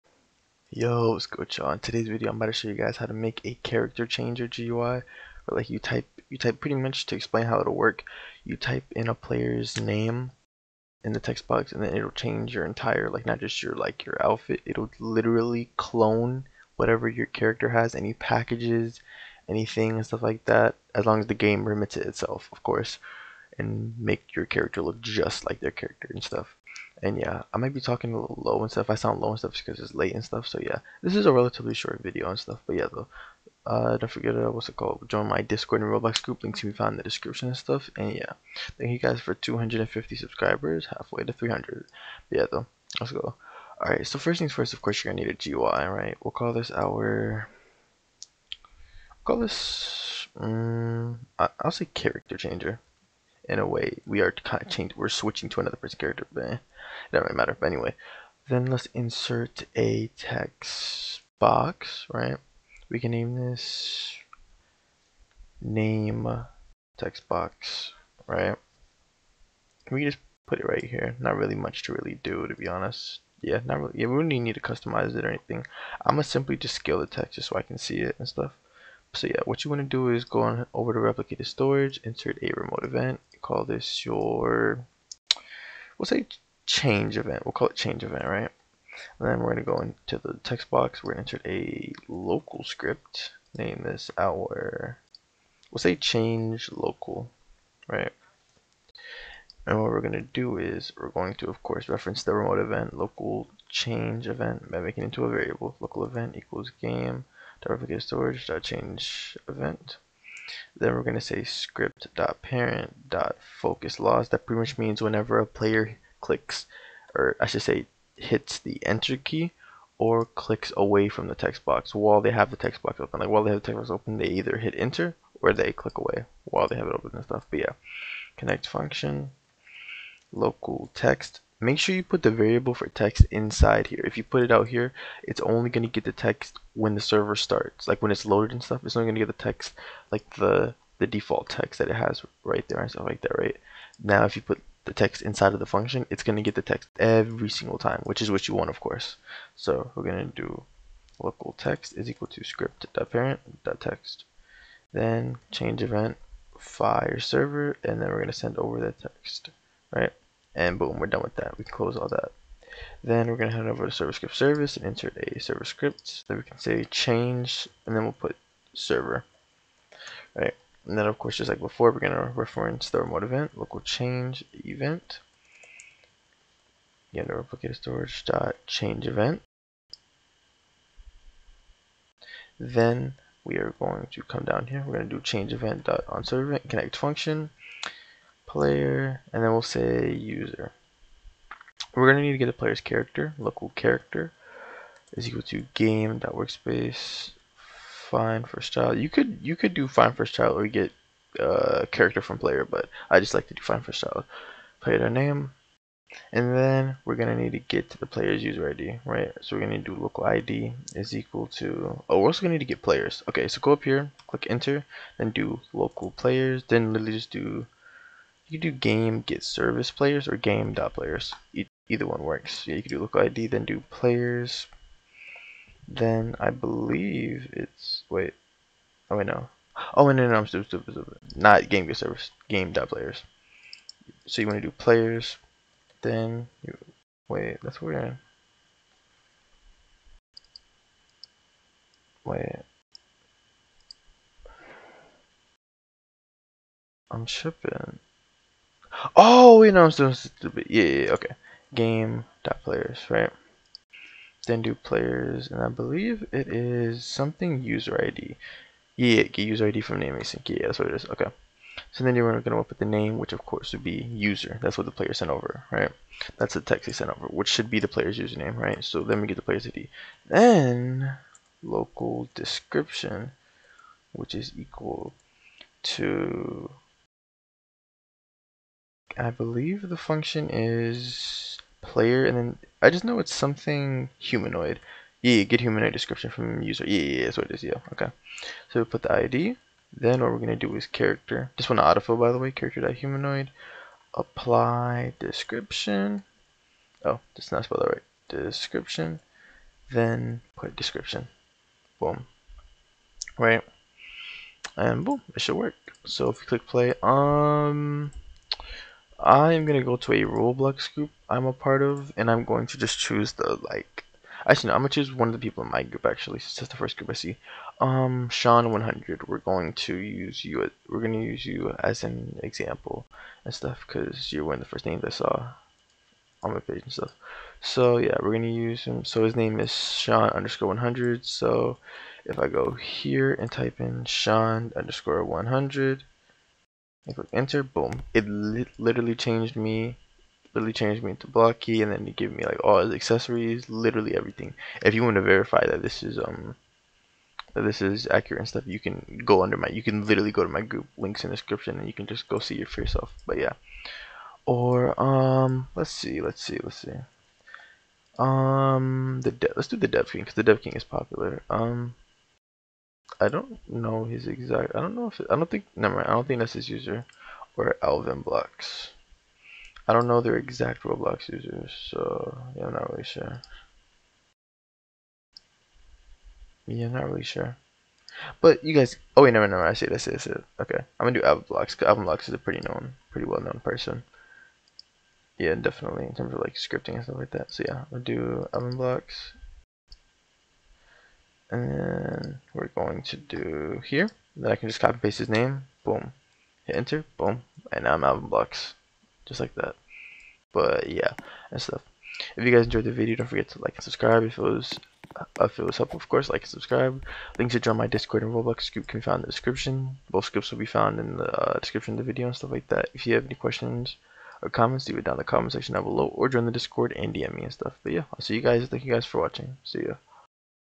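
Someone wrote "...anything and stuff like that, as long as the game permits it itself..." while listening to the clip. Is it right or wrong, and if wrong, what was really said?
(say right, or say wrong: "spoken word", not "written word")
right.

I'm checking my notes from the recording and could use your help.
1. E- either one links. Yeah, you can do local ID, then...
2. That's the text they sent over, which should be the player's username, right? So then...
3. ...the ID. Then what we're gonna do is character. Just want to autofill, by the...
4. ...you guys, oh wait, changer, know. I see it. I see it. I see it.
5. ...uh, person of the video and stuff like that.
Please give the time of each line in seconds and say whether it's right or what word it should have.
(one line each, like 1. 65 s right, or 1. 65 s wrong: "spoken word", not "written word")
1. 221 s wrong: "works", not "links"
2. 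266 s right
3. 289 s right
4. 378 s wrong: "never", not "changer"
5. 411 s wrong: "description", not "person".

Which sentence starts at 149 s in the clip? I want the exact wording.
So we're going to do local text is equal to script.parent.text.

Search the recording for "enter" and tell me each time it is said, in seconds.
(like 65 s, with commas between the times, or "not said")
118 s, 124 s, 214 s, 337 s, 396 s.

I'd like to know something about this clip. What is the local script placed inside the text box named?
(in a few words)
change local.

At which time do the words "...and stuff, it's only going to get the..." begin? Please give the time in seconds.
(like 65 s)
138 s.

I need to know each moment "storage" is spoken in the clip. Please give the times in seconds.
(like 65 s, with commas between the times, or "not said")
81 s, 108 s, 177 s.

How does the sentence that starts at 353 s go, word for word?
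But yeah, or um, let's see, let's see, let's see.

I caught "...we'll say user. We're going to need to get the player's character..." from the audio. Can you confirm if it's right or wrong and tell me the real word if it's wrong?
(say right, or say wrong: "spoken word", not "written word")
right.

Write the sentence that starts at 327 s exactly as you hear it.
So yeah, we're gonna use him.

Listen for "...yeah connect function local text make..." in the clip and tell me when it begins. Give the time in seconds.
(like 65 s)
127 s.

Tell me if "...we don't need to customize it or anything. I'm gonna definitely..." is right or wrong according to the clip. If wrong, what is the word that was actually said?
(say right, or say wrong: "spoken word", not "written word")
wrong: "simply", not "definitely".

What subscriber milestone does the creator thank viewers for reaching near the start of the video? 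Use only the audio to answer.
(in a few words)
250.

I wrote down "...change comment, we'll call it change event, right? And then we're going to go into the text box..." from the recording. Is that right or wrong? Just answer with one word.
wrong.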